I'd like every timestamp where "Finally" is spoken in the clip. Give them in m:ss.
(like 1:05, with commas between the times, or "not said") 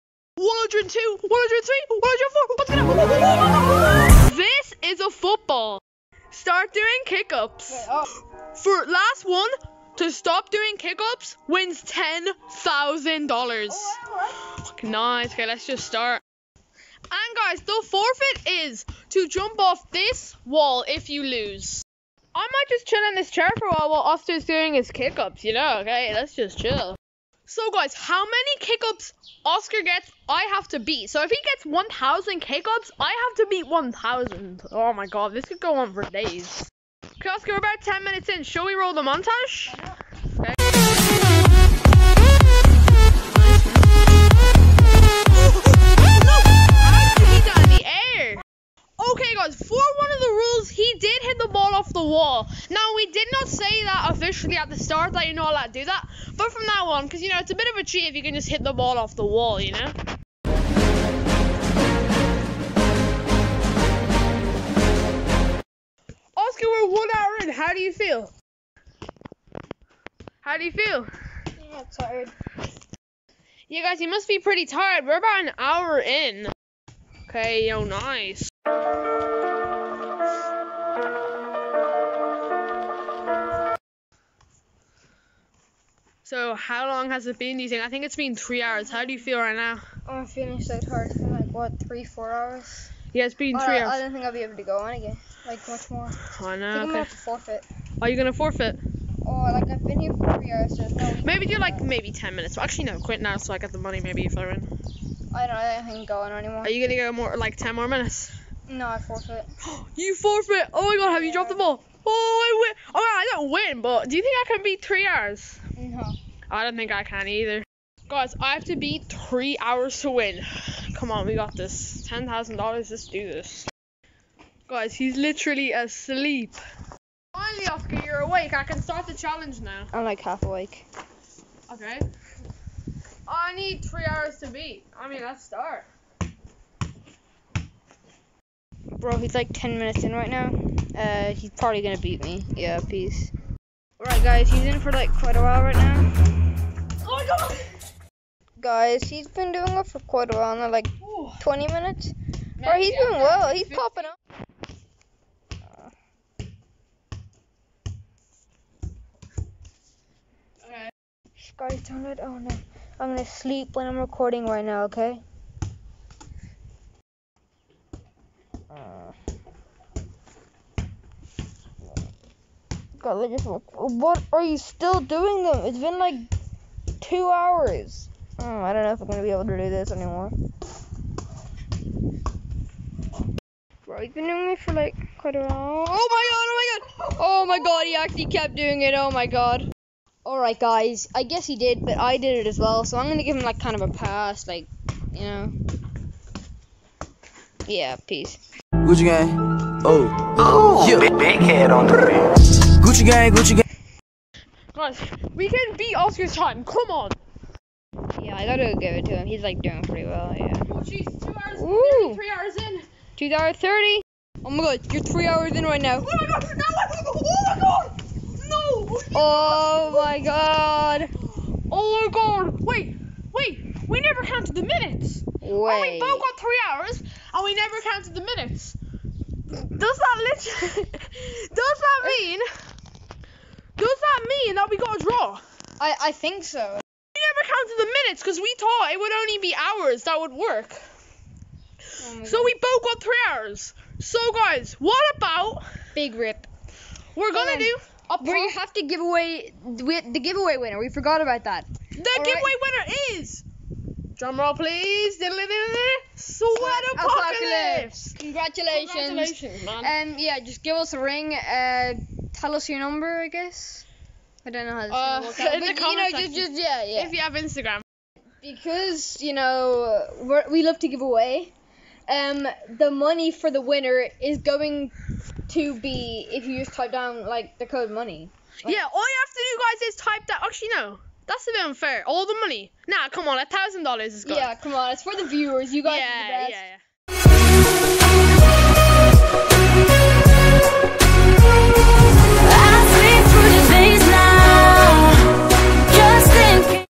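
2:07.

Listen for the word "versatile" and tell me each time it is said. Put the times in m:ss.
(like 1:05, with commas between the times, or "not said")
not said.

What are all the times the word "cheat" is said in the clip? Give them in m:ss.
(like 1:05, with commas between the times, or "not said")
0:57.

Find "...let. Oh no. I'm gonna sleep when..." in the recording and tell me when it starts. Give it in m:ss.
2:42.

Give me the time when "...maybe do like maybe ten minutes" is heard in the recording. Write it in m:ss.
1:41.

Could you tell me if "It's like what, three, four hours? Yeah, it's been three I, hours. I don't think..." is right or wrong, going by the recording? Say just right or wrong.
right.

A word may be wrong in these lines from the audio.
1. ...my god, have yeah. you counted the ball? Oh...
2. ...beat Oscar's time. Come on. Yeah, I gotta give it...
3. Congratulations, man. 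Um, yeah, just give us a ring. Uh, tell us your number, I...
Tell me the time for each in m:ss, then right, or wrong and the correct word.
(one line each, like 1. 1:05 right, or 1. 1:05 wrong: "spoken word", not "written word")
1. 1:50 wrong: "dropped", not "counted"
2. 3:25 right
3. 4:18 right.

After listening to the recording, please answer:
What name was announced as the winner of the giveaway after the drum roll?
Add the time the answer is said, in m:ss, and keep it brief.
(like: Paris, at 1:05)
Sweat apocalypse, at 4:15.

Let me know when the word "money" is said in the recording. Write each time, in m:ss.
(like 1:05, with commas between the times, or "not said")
1:43, 4:32, 4:37, 4:42.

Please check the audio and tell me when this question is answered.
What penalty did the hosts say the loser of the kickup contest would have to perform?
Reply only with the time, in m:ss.
0:19.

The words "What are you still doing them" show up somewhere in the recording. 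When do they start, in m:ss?
2:53.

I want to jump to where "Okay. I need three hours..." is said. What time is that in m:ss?
2:11.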